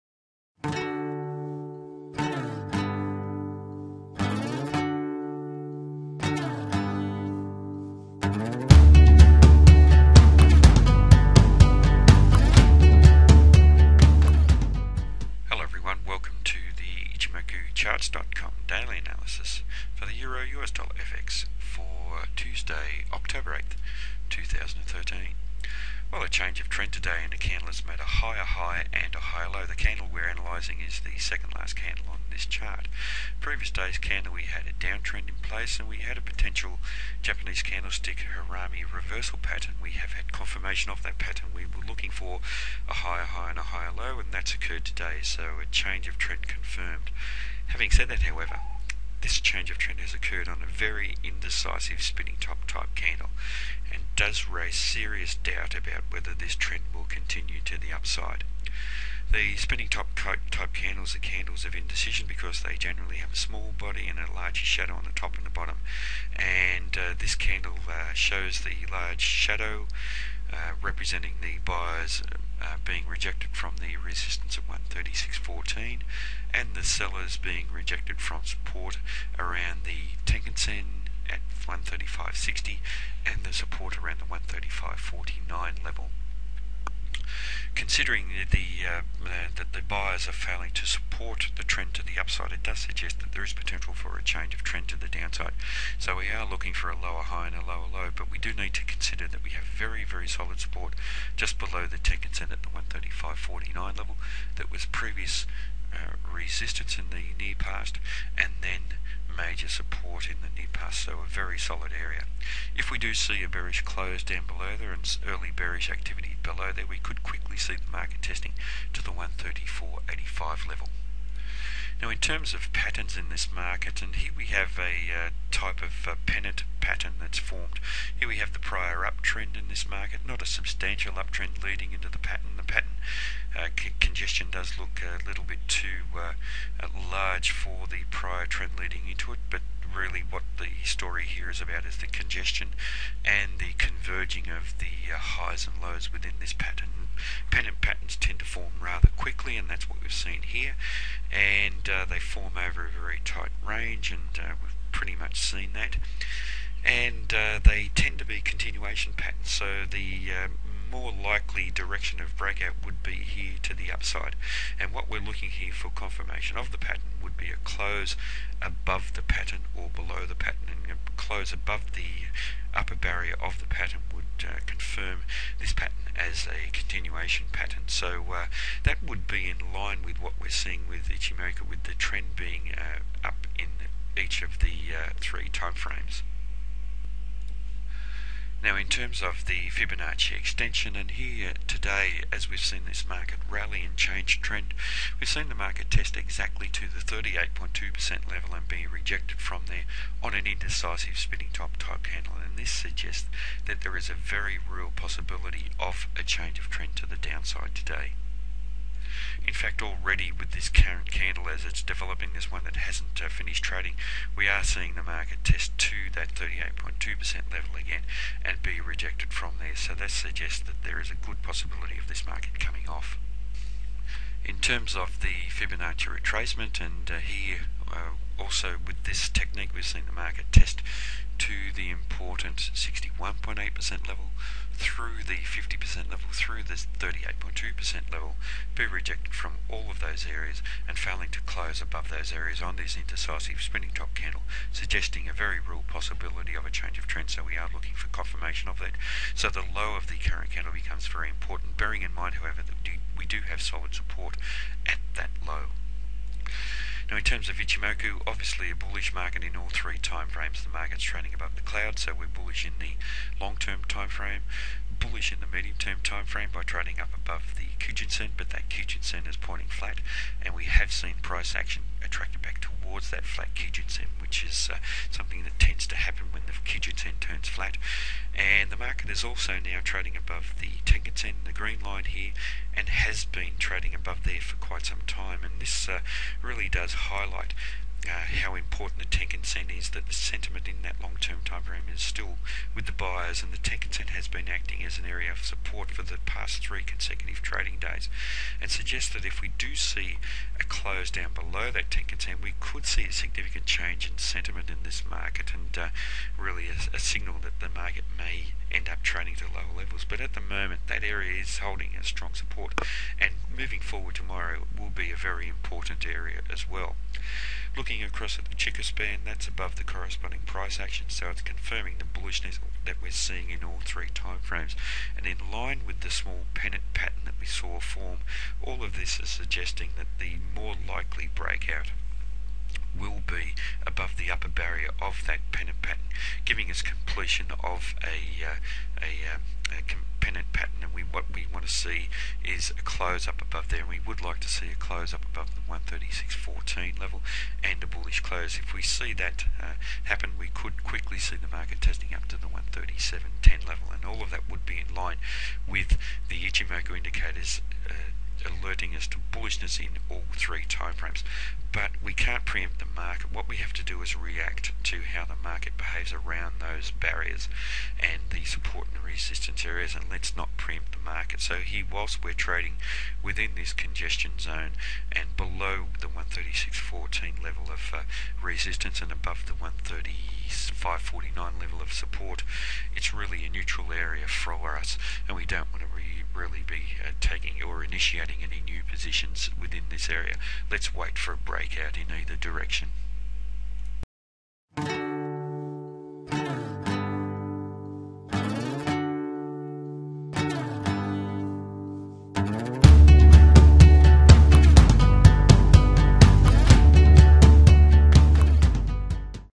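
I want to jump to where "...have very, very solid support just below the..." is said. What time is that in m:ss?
1:39.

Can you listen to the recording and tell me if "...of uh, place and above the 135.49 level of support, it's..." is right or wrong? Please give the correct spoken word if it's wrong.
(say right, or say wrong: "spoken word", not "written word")
wrong: "resistance", not "place".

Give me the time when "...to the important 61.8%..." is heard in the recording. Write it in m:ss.
3:51.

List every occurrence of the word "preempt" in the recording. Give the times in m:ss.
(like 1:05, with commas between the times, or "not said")
6:02, 6:10.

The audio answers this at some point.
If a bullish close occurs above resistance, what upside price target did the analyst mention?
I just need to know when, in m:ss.
5:52.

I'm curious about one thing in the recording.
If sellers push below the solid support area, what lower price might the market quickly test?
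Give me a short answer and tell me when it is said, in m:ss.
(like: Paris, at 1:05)
134.85, at 1:59.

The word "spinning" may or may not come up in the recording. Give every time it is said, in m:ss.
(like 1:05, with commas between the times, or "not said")
0:52, 0:59, 3:21, 4:03.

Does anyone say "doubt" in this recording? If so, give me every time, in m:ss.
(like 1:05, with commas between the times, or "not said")
0:55.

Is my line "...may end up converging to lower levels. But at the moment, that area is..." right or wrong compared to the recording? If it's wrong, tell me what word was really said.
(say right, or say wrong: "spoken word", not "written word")
wrong: "trading", not "converging".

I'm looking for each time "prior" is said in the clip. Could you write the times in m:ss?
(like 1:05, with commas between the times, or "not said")
2:08, 2:18.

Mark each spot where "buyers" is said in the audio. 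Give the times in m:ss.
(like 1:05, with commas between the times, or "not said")
1:11, 1:29, 4:52.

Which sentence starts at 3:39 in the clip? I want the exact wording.
So that suggests that there is a good possibility of this market coming off.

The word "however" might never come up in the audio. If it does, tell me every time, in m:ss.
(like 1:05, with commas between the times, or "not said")
0:48, 4:12.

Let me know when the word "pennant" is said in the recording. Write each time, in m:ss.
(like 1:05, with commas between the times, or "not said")
2:06, 2:27, 5:26, 5:35, 5:40.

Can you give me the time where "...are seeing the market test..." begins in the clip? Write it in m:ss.
3:34.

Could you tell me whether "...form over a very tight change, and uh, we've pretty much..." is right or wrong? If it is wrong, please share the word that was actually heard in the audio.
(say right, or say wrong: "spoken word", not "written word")
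wrong: "range", not "change".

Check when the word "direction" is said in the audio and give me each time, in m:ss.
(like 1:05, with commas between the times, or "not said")
2:41, 6:32.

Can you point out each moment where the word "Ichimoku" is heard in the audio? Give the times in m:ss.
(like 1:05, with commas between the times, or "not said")
3:01, 4:17, 5:56.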